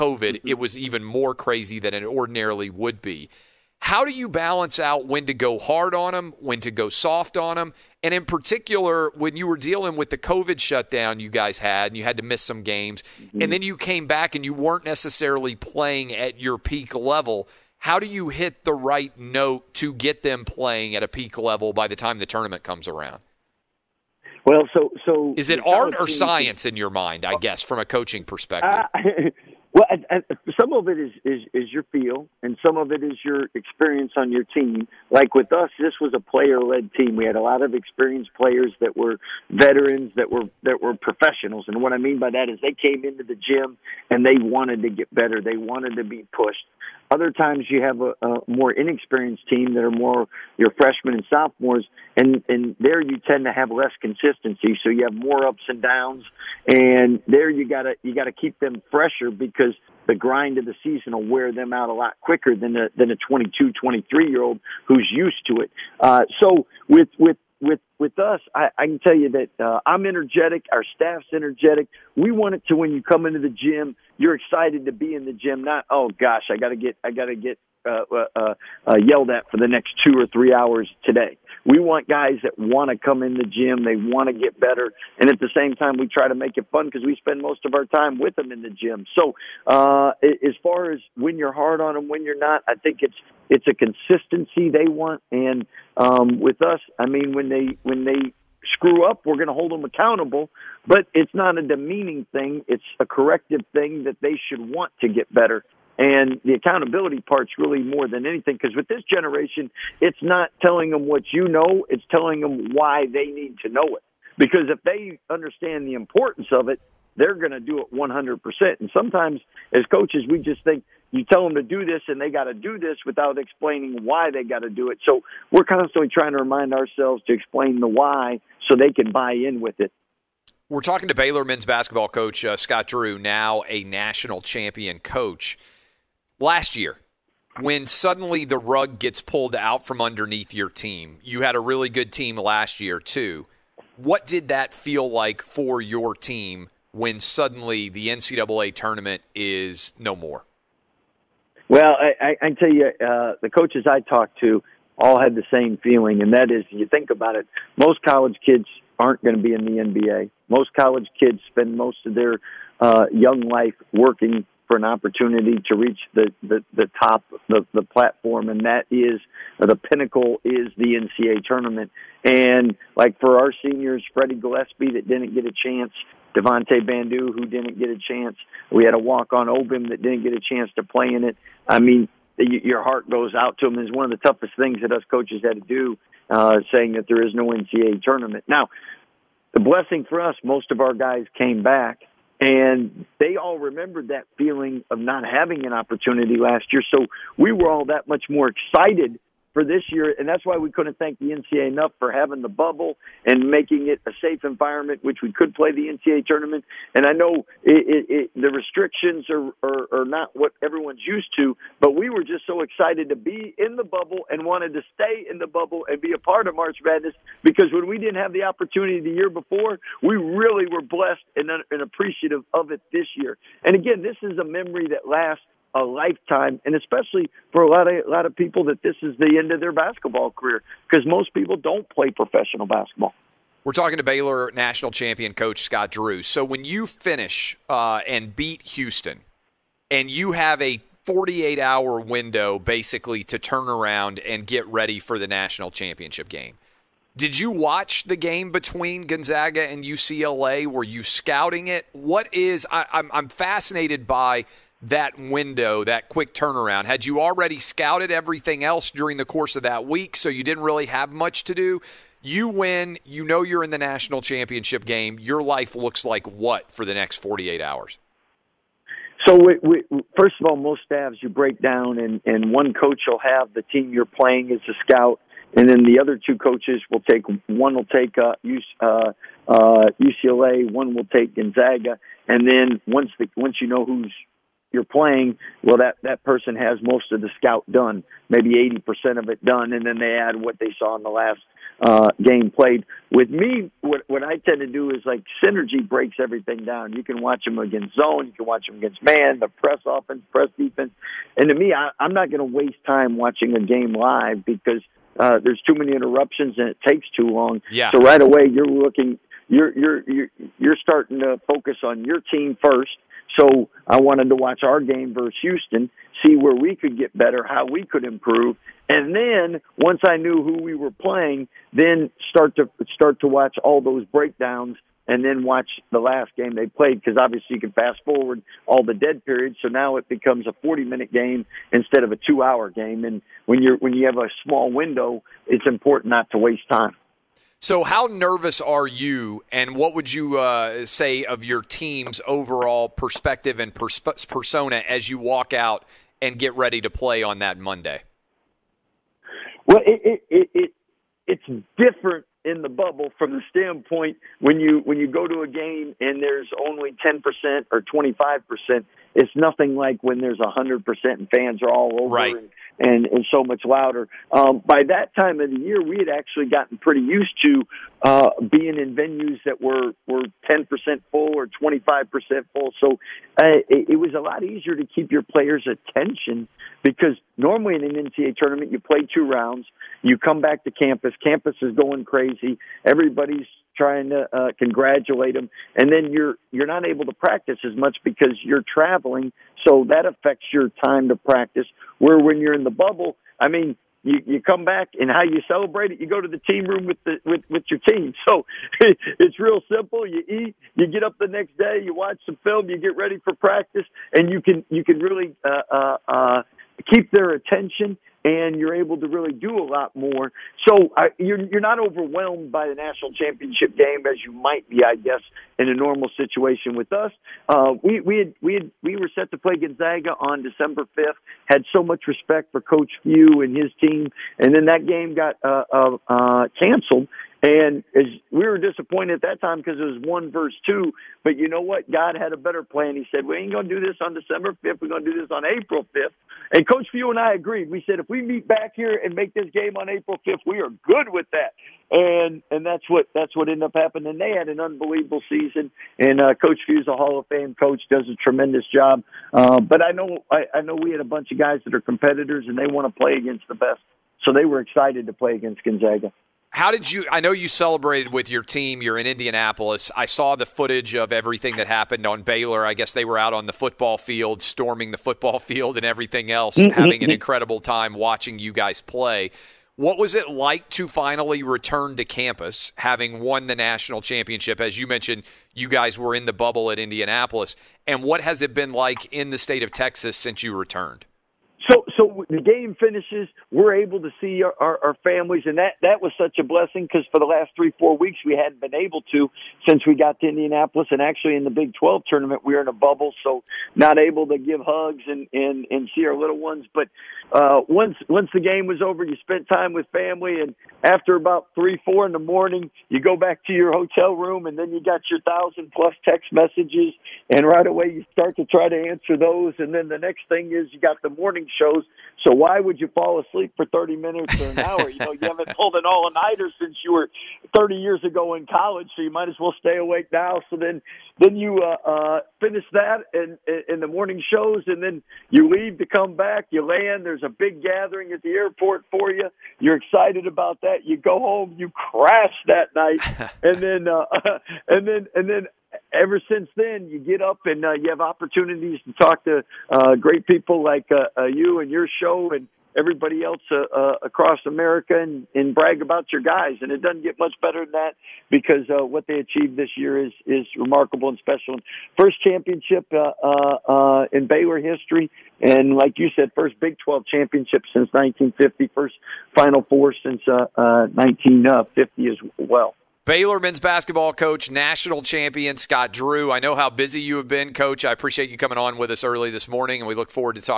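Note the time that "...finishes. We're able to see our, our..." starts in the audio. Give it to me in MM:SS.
08:02.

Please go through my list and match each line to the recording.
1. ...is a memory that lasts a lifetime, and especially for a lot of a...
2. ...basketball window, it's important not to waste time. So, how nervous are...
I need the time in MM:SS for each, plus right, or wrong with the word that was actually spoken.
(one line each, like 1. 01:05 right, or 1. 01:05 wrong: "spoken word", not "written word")
1. 03:44 right
2. 05:34 wrong: "small", not "basketball".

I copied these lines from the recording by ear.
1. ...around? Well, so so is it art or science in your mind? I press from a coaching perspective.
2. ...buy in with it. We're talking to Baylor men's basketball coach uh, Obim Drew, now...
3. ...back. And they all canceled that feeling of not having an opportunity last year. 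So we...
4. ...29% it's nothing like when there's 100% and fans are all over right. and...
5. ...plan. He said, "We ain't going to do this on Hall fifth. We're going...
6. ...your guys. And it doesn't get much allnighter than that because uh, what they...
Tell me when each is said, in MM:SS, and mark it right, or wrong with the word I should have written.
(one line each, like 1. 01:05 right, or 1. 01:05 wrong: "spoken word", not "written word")
1. 00:22 wrong: "guess", not "press"
2. 02:09 wrong: "Scott", not "Obim"
3. 03:11 wrong: "remembered", not "canceled"
4. 05:57 wrong: "25", not "29"
5. 07:12 wrong: "December", not "Hall"
6. 09:06 wrong: "better", not "allnighter".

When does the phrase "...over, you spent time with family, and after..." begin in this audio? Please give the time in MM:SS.
08:18.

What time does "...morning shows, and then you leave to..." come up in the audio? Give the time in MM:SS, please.
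08:43.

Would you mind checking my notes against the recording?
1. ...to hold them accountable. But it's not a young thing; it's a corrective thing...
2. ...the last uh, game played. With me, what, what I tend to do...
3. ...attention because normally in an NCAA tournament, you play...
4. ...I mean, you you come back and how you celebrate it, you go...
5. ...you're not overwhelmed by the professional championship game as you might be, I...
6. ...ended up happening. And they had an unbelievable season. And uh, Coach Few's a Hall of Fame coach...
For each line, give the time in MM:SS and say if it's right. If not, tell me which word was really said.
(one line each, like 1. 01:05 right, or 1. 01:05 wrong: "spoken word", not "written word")
1. 01:39 wrong: "demeaning", not "young"
2. 04:51 right
3. 06:15 right
4. 06:33 right
5. 06:51 wrong: "national", not "professional"
6. 07:23 right.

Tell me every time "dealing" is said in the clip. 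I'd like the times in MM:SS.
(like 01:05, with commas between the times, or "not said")
00:09.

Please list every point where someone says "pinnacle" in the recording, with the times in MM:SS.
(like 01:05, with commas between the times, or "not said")
02:49.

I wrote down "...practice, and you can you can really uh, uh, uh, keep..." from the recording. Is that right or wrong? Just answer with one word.
right.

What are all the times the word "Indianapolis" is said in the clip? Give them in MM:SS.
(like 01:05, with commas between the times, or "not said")
07:39, 07:56, 08:10.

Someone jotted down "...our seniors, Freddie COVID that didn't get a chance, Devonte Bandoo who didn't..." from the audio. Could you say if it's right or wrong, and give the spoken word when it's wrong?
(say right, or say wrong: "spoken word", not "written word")
wrong: "Gillespie", not "COVID".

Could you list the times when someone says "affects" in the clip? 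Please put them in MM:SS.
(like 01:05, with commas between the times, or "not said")
06:30.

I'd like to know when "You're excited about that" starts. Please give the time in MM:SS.
08:49.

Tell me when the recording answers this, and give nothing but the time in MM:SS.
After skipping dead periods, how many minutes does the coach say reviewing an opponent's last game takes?
05:30.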